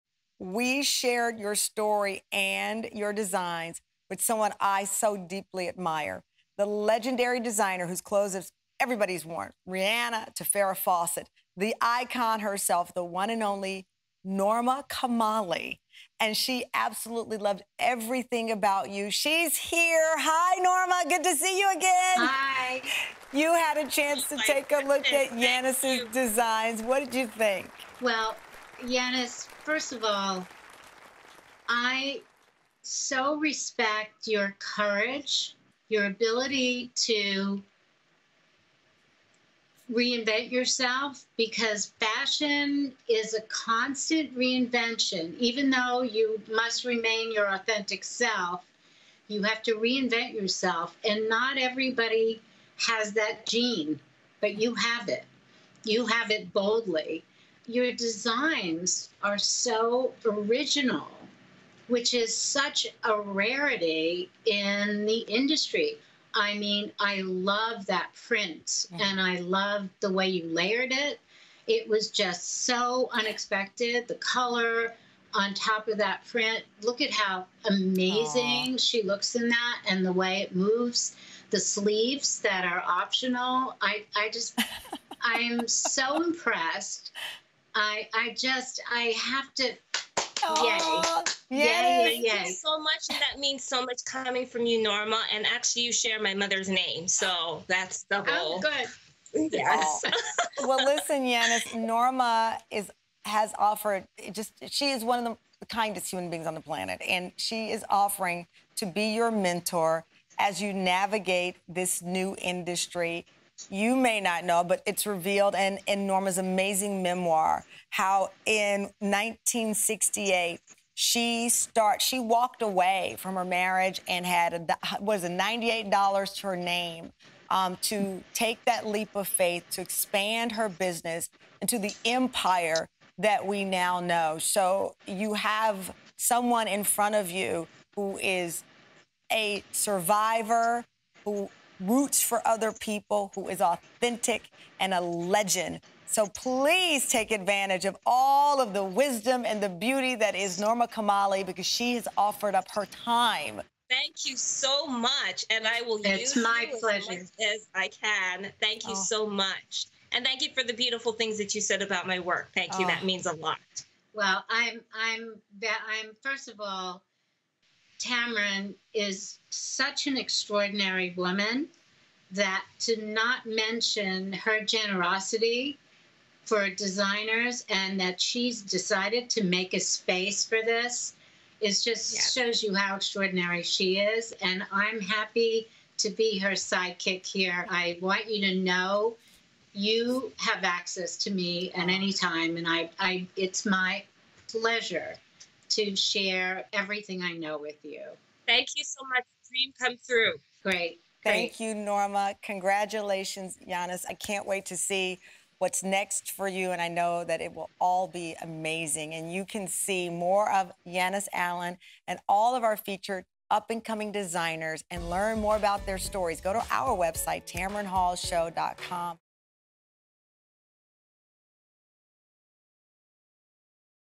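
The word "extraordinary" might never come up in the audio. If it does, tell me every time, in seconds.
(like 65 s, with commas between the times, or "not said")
170 s, 182 s.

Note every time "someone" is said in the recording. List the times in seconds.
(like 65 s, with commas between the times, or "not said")
4 s, 136 s.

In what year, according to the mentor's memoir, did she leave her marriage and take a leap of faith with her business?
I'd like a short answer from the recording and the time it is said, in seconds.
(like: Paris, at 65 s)
1968, at 118 s.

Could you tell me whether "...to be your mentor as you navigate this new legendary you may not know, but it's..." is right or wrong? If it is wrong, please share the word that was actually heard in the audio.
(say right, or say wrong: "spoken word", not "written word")
wrong: "industry", not "legendary".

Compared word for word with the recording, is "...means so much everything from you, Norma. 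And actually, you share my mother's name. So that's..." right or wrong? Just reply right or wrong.
wrong.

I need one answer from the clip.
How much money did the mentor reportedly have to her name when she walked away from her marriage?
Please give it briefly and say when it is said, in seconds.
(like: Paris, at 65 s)
$98, at 125 s.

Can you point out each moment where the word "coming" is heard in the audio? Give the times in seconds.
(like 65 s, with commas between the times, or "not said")
94 s, 213 s.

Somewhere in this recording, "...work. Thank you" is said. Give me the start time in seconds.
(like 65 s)
162 s.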